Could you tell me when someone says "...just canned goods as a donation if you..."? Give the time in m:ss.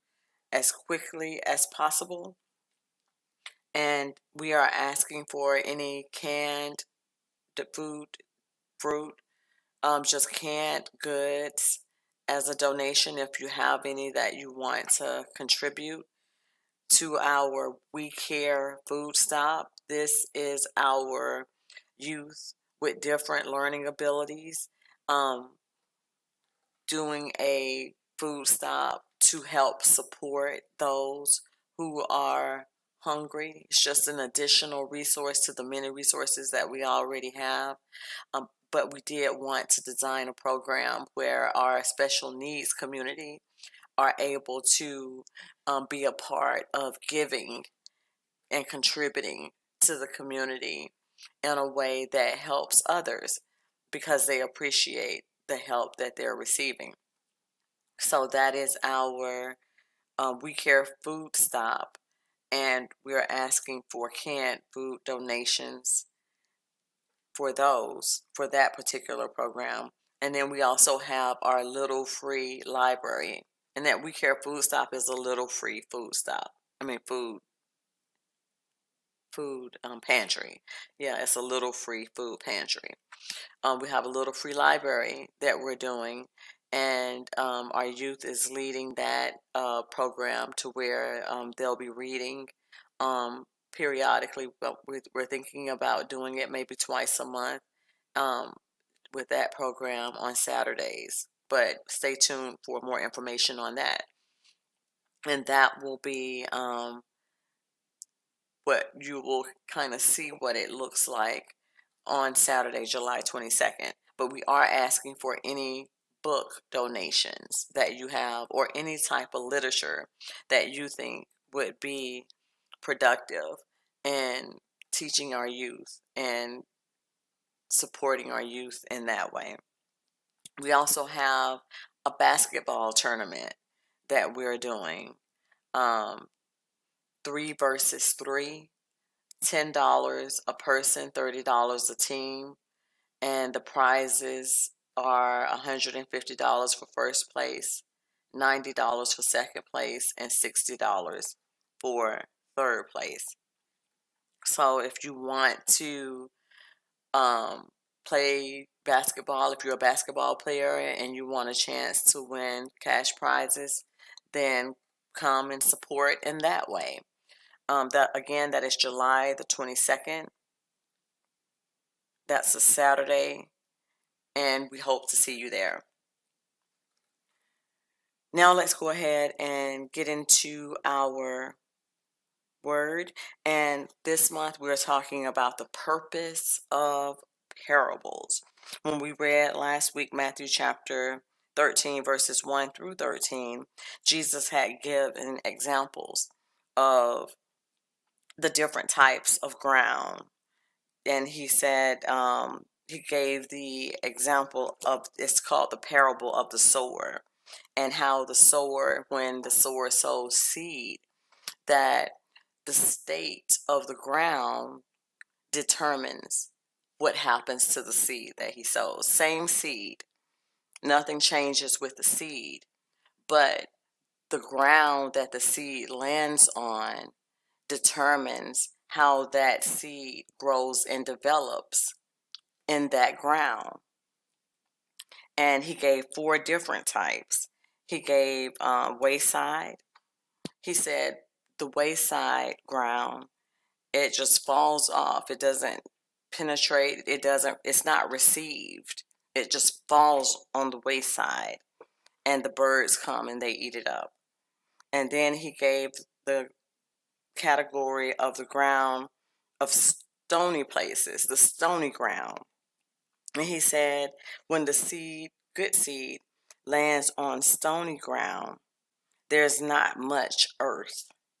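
0:10.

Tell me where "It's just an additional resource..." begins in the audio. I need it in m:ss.
0:33.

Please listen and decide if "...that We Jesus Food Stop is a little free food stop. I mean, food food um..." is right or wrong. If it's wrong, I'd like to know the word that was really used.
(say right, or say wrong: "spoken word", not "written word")
wrong: "Care", not "Jesus".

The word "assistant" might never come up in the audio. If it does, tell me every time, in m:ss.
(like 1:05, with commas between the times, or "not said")
not said.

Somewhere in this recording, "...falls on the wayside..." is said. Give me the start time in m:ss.
4:09.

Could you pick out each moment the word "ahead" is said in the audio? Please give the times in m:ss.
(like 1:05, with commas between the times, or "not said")
2:58.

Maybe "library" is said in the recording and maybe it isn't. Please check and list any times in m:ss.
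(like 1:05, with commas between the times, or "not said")
1:12, 1:24.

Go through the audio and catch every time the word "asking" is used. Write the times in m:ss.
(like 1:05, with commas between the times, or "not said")
0:04, 1:03, 1:54.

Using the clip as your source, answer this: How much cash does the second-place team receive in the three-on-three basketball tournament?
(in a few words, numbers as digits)
$90.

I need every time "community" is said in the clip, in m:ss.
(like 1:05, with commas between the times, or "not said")
0:42, 0:50.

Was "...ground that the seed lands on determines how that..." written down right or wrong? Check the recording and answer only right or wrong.
right.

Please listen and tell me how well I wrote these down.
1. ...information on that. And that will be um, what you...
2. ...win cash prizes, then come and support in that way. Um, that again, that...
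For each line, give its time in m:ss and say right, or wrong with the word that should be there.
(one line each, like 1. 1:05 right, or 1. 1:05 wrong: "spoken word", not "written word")
1. 1:42 right
2. 2:42 right.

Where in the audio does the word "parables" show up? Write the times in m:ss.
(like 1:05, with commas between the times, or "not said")
3:07, 3:25.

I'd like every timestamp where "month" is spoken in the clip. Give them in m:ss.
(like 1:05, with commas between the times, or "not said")
1:37, 3:04.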